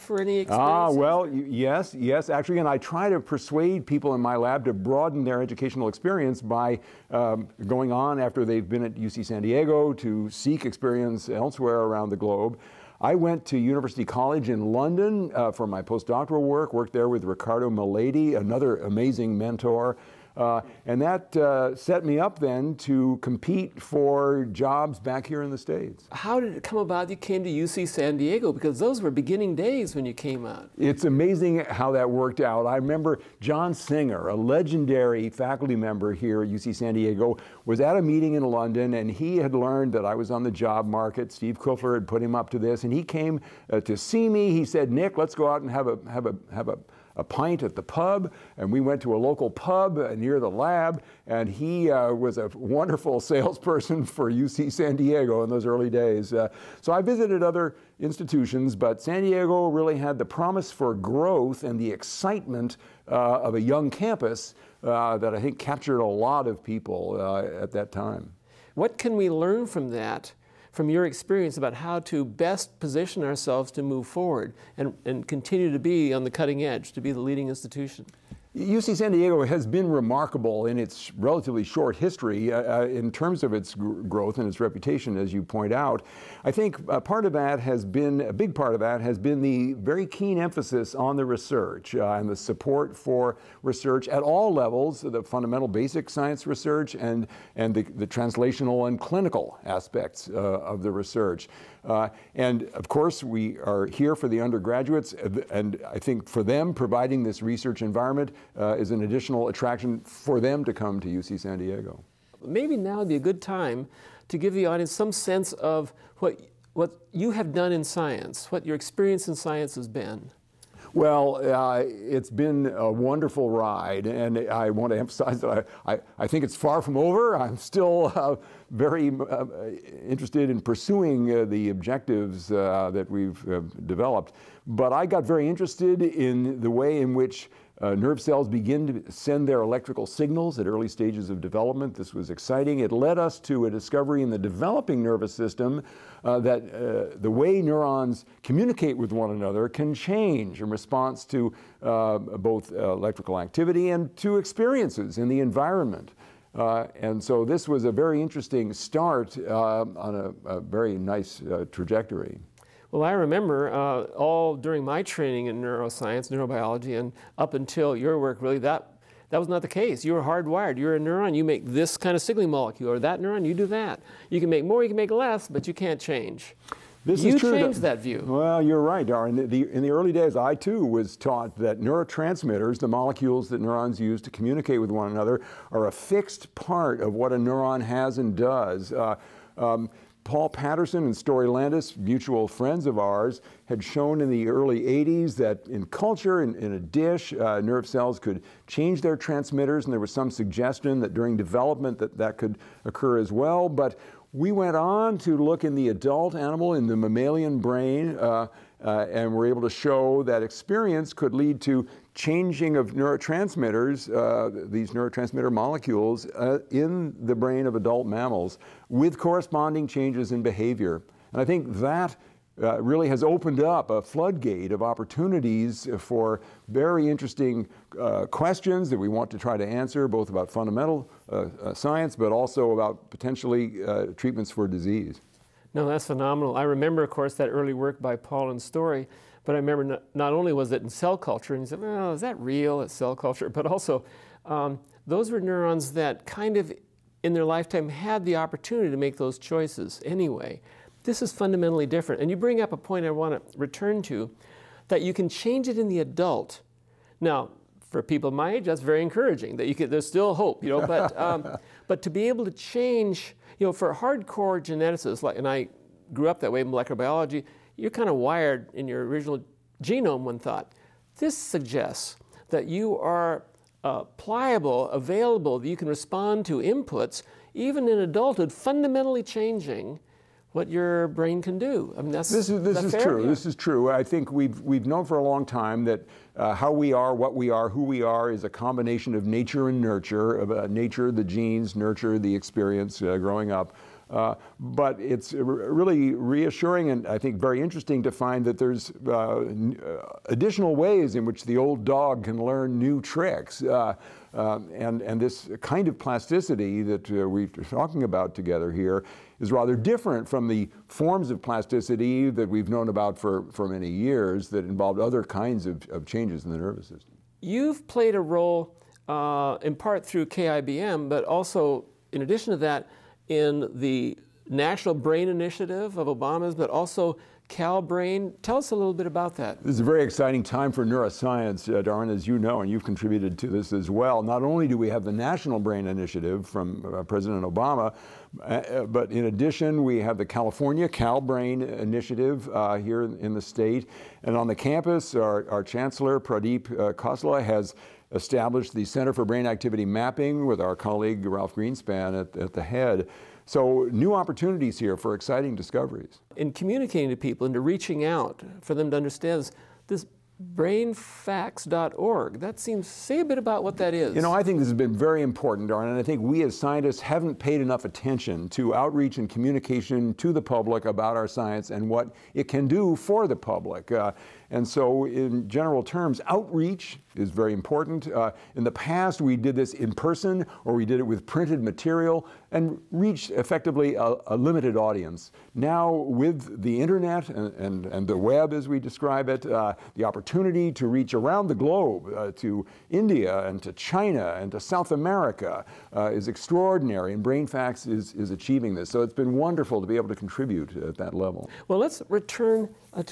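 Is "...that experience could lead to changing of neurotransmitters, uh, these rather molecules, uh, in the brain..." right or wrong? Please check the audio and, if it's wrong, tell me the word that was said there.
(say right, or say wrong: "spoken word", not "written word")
wrong: "neurotransmitter", not "rather".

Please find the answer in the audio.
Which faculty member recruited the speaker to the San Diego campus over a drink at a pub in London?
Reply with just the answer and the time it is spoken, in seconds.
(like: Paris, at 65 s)
John Singer, at 33 s.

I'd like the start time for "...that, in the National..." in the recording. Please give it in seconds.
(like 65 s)
322 s.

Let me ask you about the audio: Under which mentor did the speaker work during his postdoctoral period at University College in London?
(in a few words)
Ricardo Miledi.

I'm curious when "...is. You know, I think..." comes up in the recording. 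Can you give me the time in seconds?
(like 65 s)
363 s.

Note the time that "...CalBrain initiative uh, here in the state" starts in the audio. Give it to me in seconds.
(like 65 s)
340 s.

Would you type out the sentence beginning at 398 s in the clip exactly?
So it's been wonderful to be able to contribute at that level.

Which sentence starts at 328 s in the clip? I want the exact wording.
Tell us a little bit about that.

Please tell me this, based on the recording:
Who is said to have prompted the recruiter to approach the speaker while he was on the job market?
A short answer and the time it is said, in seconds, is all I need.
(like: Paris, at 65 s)
Steve Kuffler, at 41 s.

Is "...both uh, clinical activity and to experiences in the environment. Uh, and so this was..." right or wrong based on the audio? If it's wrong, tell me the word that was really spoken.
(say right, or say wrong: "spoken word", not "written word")
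wrong: "electrical", not "clinical".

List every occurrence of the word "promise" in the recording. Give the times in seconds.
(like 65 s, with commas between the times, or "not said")
60 s.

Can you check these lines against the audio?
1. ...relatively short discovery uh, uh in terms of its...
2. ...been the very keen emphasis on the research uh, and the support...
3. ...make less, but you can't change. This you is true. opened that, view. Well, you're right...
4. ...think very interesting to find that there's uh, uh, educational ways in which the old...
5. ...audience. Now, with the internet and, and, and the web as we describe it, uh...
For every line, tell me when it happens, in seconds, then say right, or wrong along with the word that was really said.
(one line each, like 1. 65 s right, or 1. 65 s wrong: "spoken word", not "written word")
1. 81 s wrong: "history", not "discovery"
2. 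89 s right
3. 174 s wrong: "changed", not "opened"
4. 297 s wrong: "additional", not "educational"
5. 384 s right.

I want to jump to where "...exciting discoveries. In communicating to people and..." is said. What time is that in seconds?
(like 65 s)
355 s.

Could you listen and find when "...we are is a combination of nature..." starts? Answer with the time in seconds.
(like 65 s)
287 s.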